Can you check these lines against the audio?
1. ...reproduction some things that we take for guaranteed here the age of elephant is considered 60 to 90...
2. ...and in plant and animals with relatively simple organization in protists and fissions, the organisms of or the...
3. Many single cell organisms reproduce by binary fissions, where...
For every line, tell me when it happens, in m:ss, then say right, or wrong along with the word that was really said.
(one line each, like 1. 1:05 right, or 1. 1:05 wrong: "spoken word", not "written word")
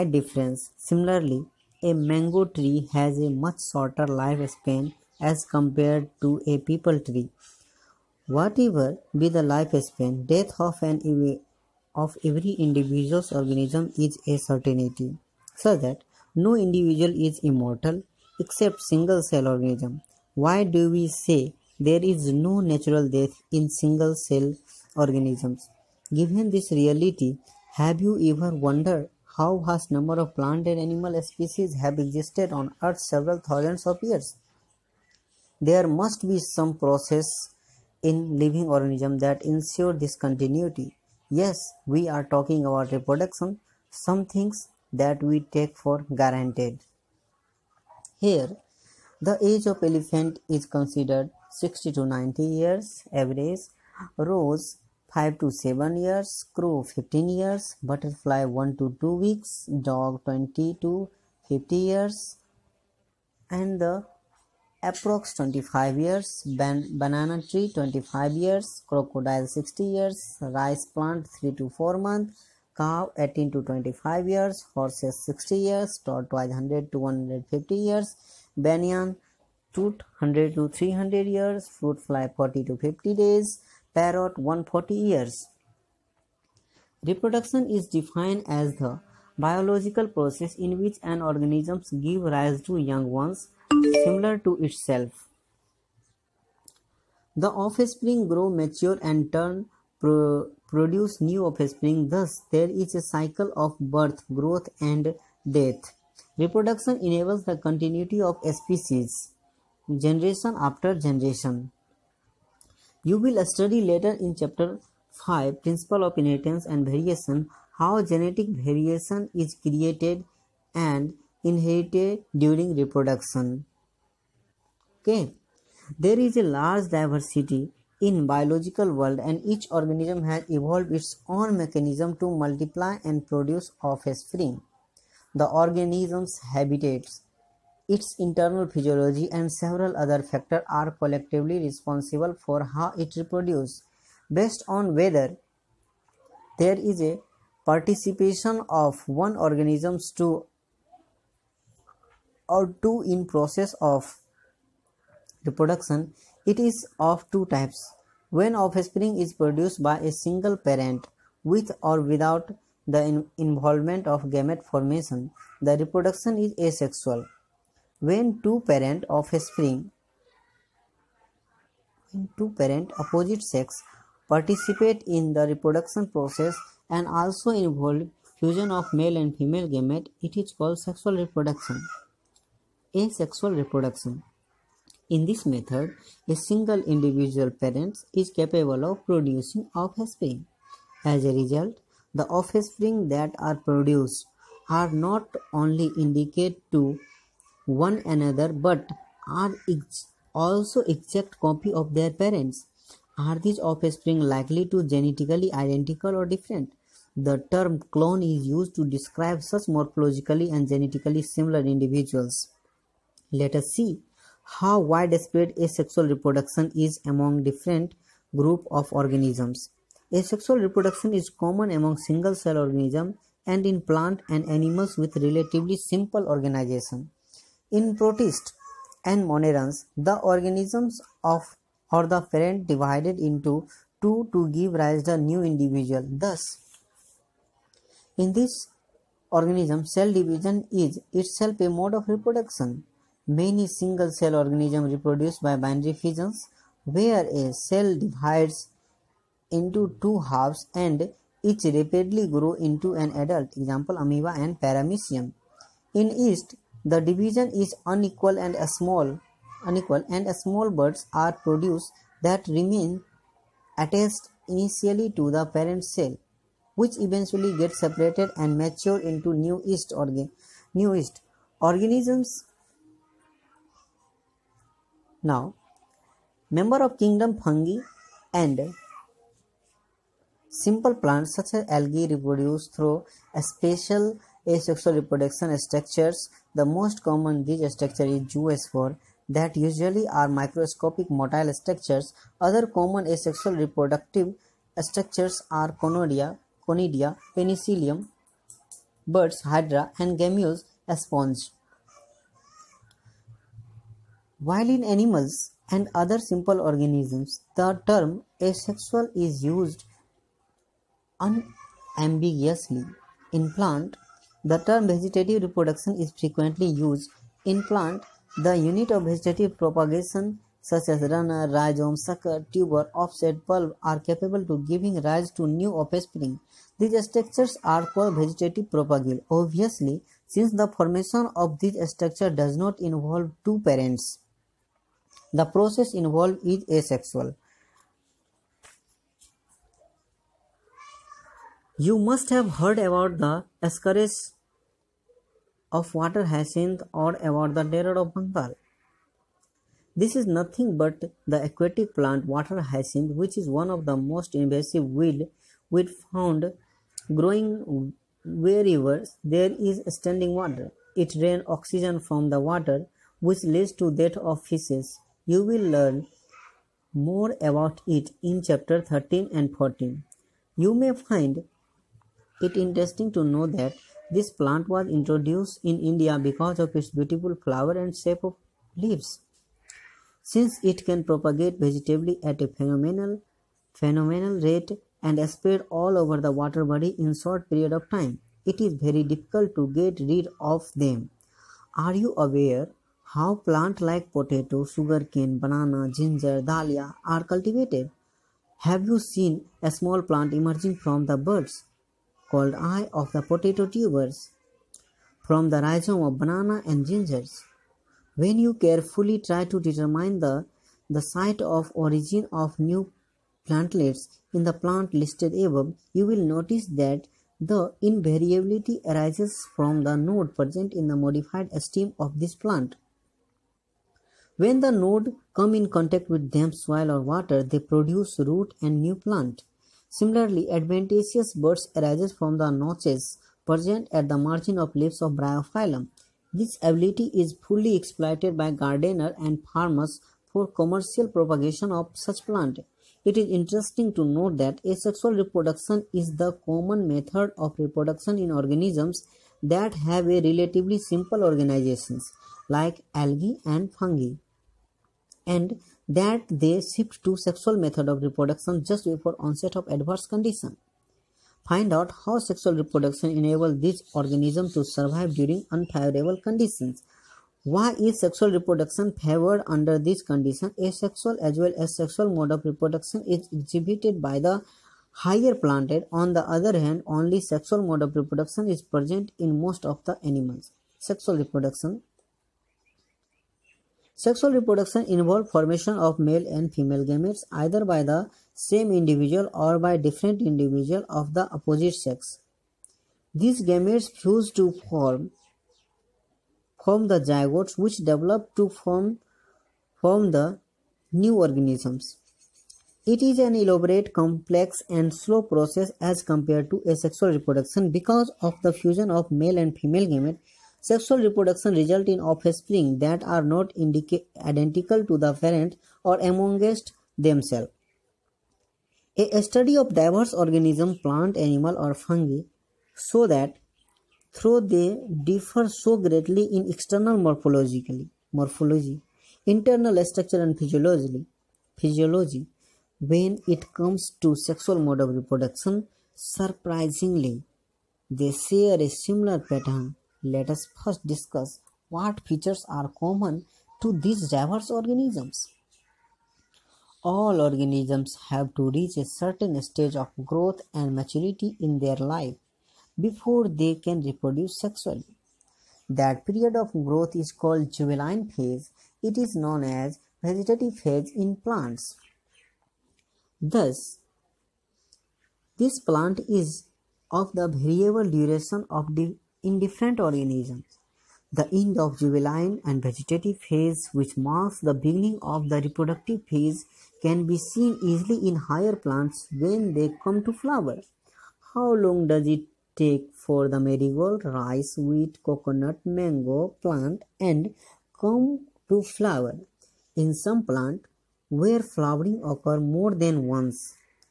1. 0:42 right
2. 3:43 wrong: "monerans", not "fissions"
3. 4:03 right.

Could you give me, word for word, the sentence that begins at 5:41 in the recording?
You must have heard about the Ascaris of water hyacinth or about the terror of Bengal.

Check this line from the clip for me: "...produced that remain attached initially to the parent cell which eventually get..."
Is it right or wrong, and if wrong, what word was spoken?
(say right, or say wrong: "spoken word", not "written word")
right.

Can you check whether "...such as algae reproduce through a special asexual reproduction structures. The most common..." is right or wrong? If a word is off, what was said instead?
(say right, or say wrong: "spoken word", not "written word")
right.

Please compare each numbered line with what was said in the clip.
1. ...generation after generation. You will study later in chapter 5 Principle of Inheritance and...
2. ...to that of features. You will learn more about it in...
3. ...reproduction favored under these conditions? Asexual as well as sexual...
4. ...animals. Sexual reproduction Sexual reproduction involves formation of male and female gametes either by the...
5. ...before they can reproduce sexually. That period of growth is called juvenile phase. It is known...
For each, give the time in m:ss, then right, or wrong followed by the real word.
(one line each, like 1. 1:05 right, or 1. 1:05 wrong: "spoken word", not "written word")
1. 1:49 right
2. 6:03 wrong: "fishes", not "features"
3. 7:48 right
4. 8:00 right
5. 9:12 right.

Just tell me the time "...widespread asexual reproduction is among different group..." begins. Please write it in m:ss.
3:34.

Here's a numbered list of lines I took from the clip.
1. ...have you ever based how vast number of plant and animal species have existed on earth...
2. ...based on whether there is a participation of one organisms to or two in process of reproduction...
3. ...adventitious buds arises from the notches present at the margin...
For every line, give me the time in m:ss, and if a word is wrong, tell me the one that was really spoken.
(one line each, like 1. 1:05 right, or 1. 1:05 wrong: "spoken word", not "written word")
1. 0:27 wrong: "wondered", not "based"
2. 2:24 right
3. 7:10 right.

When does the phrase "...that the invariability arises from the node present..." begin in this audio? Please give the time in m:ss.
6:56.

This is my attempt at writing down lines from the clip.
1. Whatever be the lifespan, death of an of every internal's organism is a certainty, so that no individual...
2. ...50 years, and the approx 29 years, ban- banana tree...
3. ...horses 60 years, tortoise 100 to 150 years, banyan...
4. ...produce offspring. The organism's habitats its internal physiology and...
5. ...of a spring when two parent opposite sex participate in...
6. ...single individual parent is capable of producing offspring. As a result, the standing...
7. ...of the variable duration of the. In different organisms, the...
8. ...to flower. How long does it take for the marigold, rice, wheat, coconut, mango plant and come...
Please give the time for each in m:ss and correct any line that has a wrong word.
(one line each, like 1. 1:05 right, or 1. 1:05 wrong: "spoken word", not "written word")
1. 0:08 wrong: "individual", not "internal"
2. 1:01 wrong: "25", not "29"
3. 1:14 right
4. 2:13 right
5. 2:49 right
6. 3:06 wrong: "offspring", not "standing"
7. 9:26 right
8. 9:40 right.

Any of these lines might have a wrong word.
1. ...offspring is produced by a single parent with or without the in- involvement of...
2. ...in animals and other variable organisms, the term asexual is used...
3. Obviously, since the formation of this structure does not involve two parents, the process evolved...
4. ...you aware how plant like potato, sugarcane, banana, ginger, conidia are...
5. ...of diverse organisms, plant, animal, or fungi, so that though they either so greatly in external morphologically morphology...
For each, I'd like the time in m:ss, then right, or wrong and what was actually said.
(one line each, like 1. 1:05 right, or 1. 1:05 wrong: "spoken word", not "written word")
1. 2:38 right
2. 5:04 wrong: "simple", not "variable"
3. 5:29 wrong: "involved", not "evolved"
4. 6:31 wrong: "dahlia", not "conidia"
5. 8:39 wrong: "differ", not "either".